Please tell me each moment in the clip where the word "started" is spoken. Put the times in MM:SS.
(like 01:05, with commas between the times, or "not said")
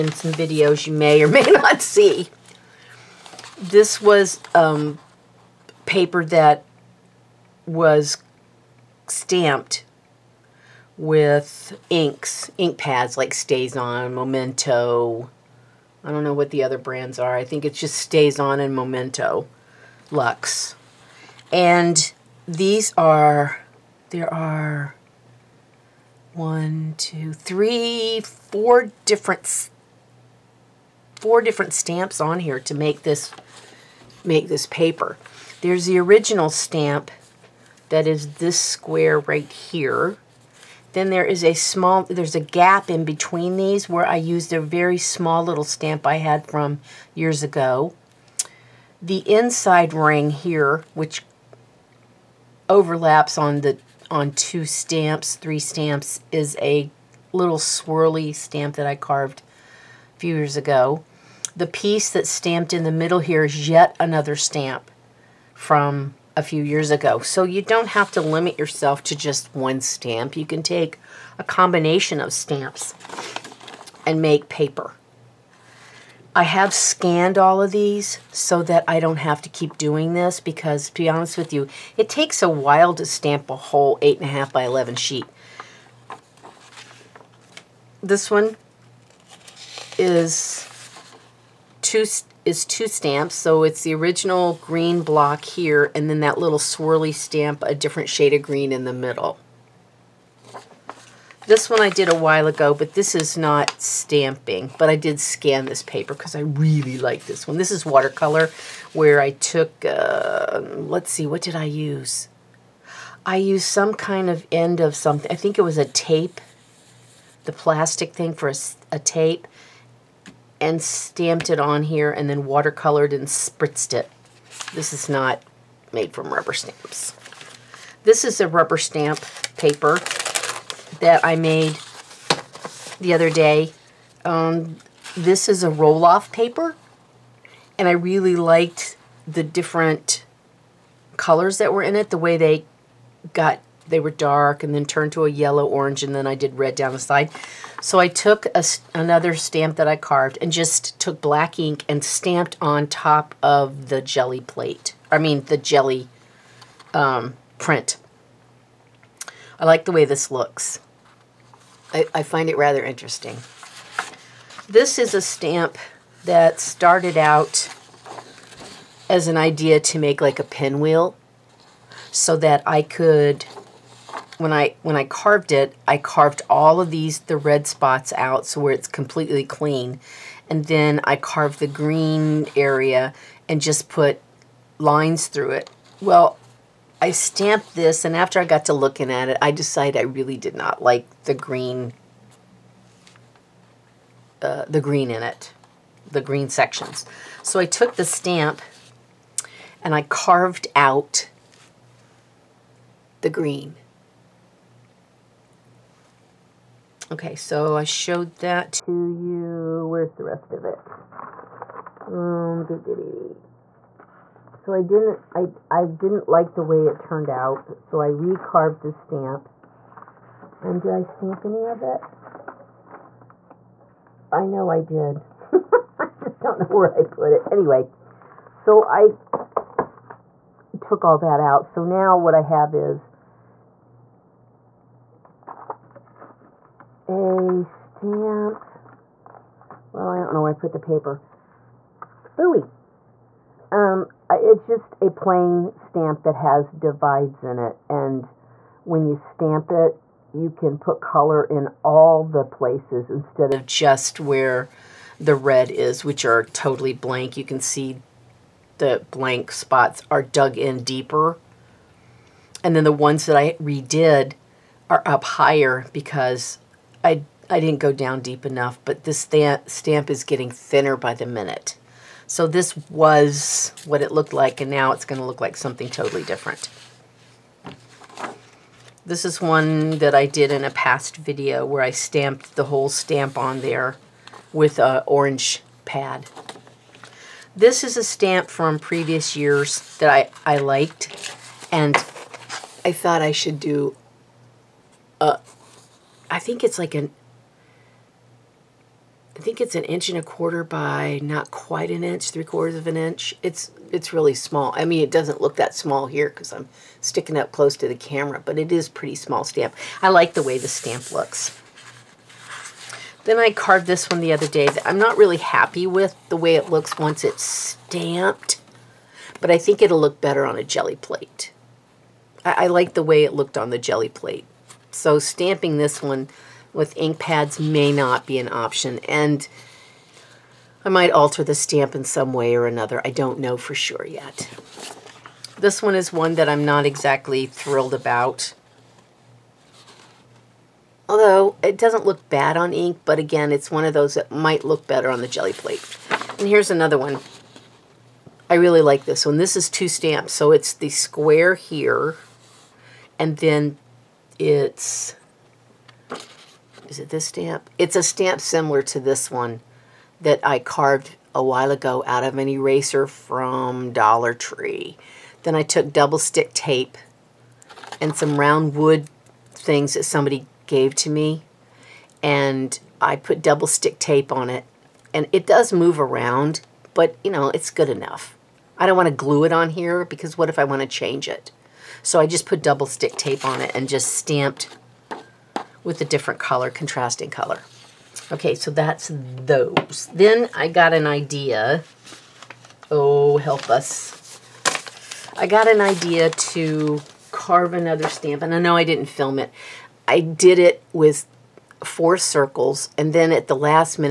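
02:46.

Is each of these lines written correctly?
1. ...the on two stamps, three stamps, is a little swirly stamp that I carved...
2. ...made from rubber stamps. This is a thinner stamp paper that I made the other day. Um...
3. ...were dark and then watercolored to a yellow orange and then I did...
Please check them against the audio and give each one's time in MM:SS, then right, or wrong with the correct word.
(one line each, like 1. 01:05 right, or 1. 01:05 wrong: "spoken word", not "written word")
1. 00:53 right
2. 02:05 wrong: "rubber", not "thinner"
3. 02:23 wrong: "turned", not "watercolored".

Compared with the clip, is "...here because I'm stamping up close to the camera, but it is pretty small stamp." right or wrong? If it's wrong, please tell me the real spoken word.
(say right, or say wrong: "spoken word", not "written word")
wrong: "sticking", not "stamping".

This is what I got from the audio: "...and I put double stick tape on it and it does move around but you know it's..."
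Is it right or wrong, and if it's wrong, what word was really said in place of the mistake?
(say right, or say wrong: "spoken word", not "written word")
right.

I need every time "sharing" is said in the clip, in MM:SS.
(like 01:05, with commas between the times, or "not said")
not said.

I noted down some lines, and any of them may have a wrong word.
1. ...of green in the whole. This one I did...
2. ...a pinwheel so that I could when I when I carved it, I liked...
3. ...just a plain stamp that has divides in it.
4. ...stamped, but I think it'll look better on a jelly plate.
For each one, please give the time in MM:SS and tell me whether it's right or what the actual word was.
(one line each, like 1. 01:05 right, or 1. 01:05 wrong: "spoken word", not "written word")
1. 01:38 wrong: "middle", not "whole"
2. 02:50 wrong: "carved", not "liked"
3. 04:04 right
4. 05:17 right.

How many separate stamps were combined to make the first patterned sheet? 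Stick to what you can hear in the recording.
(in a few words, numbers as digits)
4.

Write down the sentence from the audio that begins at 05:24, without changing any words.
So stamping this one with ink pads may not be an option.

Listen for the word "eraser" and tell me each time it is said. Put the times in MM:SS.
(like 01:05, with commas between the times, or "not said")
06:02.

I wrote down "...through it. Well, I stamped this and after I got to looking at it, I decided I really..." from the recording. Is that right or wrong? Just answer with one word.
right.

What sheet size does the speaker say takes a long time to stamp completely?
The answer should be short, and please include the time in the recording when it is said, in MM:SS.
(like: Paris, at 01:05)
8.5 by 11, at 01:23.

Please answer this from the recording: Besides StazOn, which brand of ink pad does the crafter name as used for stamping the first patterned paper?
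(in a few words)
Memento Luxe.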